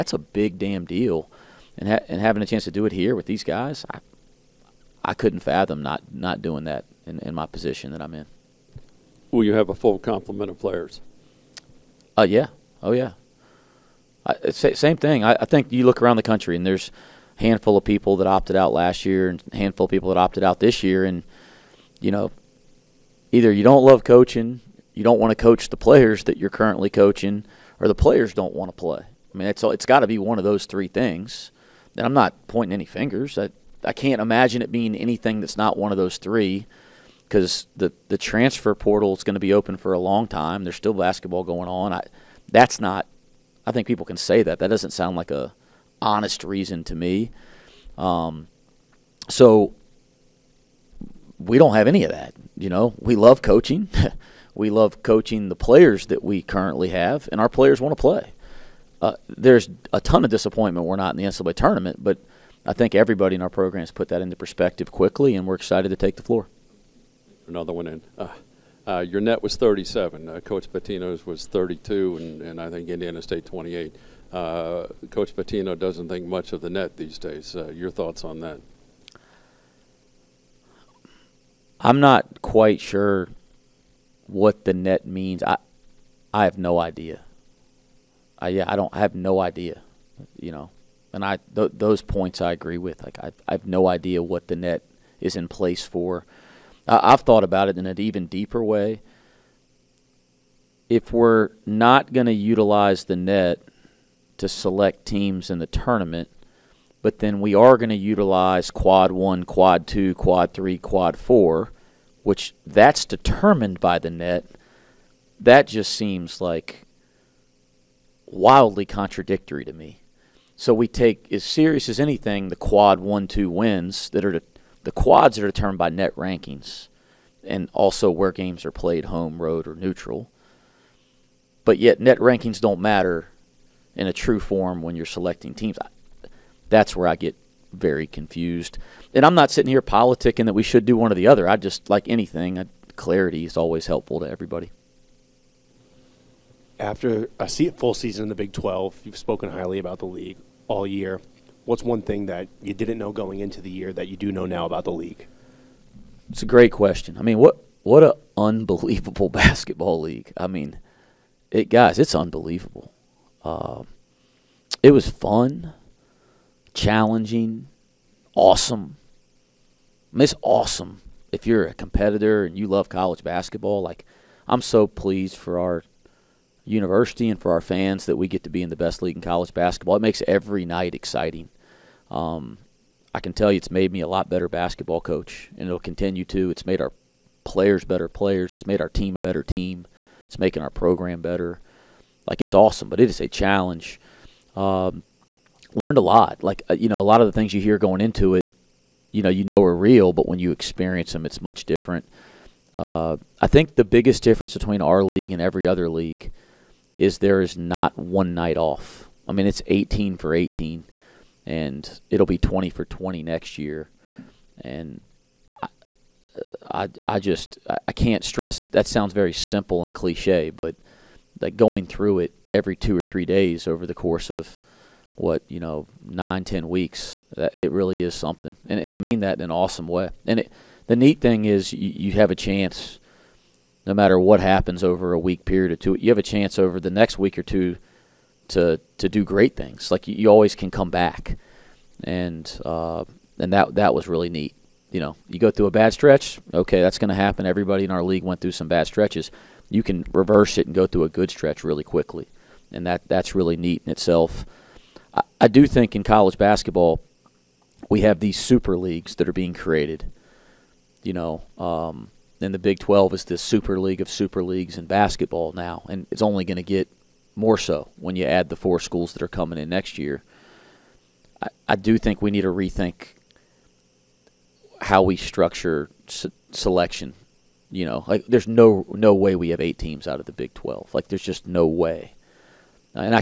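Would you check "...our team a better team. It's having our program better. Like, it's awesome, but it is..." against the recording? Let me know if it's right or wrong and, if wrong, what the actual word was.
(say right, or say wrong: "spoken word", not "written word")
wrong: "making", not "having".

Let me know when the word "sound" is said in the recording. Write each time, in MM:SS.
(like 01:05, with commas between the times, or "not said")
00:44, 03:38.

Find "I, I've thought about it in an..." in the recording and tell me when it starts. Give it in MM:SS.
01:36.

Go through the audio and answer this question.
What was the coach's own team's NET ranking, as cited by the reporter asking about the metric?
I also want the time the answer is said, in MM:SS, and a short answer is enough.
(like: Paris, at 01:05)
37, at 01:09.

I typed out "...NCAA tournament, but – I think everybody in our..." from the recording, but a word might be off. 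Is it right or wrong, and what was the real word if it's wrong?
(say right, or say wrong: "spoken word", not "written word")
right.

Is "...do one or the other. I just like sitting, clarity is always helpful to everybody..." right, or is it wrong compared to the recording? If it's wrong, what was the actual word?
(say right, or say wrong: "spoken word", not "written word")
wrong: "anything", not "sitting".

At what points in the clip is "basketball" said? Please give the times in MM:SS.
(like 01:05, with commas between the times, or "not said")
00:40, 02:39, 02:53, 02:59, 03:04, 04:16, 04:24.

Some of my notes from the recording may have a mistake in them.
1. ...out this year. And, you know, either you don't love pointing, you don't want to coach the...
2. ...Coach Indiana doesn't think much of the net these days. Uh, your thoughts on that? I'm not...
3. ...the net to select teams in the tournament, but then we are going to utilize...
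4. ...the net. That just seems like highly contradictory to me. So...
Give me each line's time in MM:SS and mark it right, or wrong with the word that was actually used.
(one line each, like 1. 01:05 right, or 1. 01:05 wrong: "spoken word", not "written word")
1. 00:20 wrong: "coaching", not "pointing"
2. 01:15 wrong: "Patino", not "Indiana"
3. 01:43 right
4. 01:53 wrong: "wildly", not "highly".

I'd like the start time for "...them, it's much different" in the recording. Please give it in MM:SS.
03:21.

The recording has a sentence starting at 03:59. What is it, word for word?
Like you, you always can come back, and uh, and that that was really neat.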